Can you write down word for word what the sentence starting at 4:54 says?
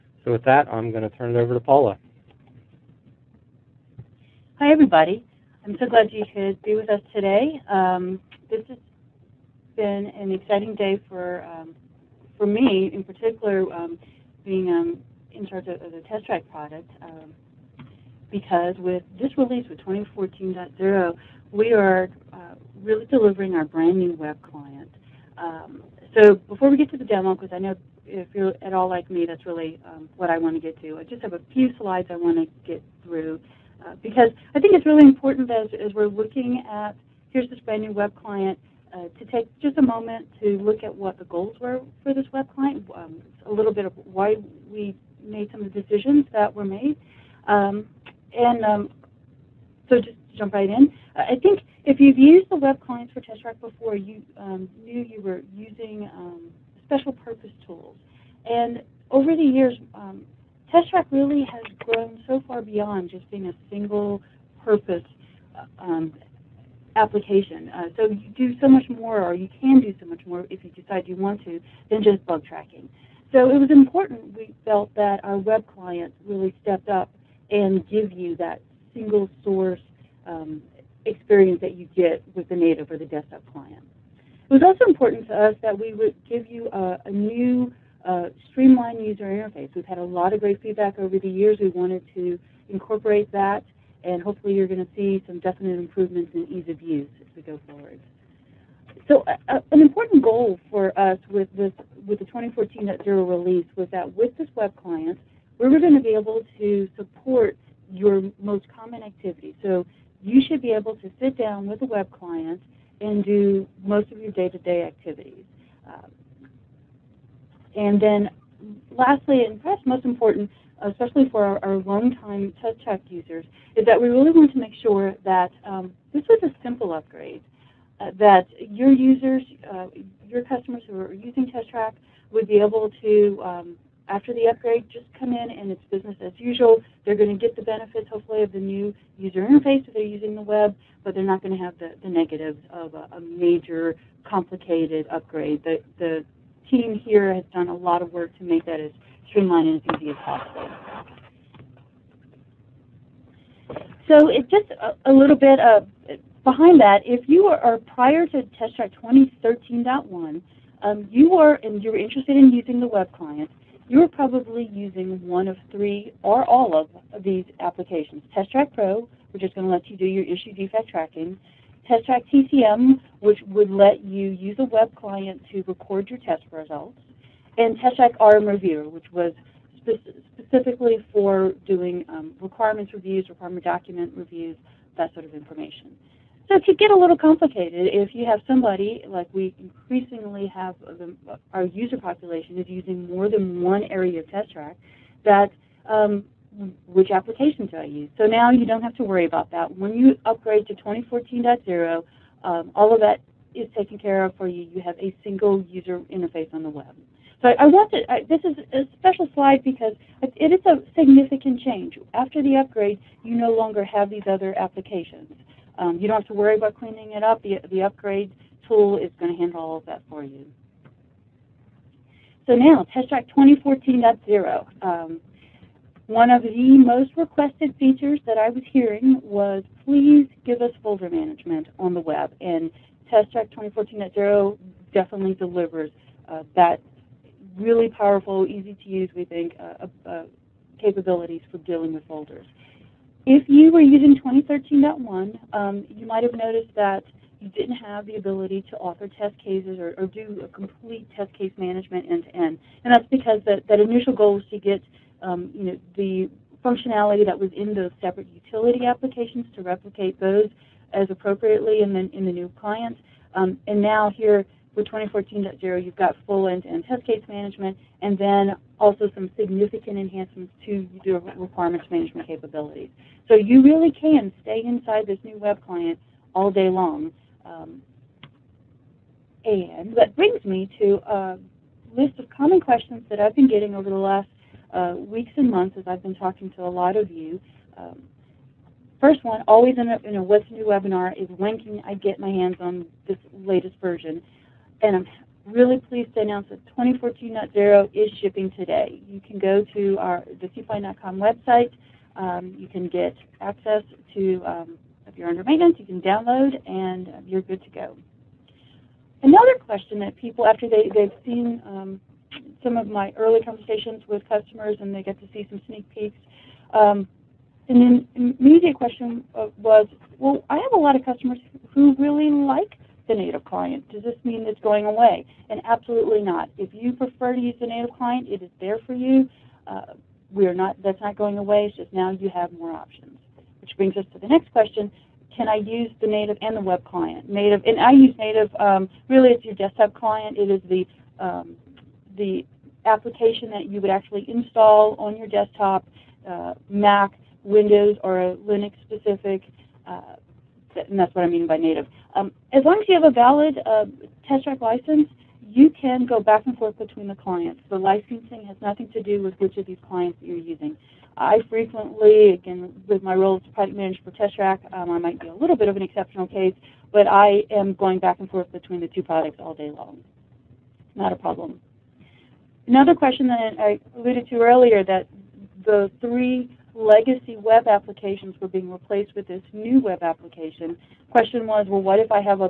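and I'm really pleased to announce that 2014.0 is shipping today.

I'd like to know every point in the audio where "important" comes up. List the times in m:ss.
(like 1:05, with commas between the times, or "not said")
0:35, 1:13, 1:24, 1:39, 2:00.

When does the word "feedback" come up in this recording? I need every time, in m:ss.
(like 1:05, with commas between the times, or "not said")
1:30.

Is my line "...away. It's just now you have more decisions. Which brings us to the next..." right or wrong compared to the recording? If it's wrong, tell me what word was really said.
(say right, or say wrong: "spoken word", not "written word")
wrong: "options", not "decisions".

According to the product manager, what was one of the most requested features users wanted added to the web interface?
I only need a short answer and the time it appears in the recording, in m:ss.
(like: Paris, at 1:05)
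Folder management, at 3:50.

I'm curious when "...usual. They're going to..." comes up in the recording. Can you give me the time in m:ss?
2:16.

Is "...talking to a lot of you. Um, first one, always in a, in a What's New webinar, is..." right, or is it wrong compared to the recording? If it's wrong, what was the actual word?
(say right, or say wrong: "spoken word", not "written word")
right.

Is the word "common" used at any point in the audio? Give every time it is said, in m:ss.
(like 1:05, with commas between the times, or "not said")
1:48, 4:42.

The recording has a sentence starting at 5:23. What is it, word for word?
Does this mean it's going away?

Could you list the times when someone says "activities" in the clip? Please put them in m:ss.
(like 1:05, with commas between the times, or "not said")
1:49, 1:54.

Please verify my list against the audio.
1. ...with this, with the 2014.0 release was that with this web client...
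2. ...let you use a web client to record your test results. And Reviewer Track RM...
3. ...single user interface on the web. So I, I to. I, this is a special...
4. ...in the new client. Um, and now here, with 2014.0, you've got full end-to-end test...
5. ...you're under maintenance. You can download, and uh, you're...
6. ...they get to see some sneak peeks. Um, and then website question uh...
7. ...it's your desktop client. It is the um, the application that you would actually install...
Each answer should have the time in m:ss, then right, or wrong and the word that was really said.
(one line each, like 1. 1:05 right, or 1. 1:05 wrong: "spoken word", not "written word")
1. 1:41 right
2. 2:53 wrong: "Test", not "Reviewer"
3. 3:25 right
4. 4:22 right
5. 5:05 right
6. 5:14 wrong: "immediate", not "website"
7. 5:39 right.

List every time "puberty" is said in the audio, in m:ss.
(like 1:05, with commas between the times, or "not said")
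not said.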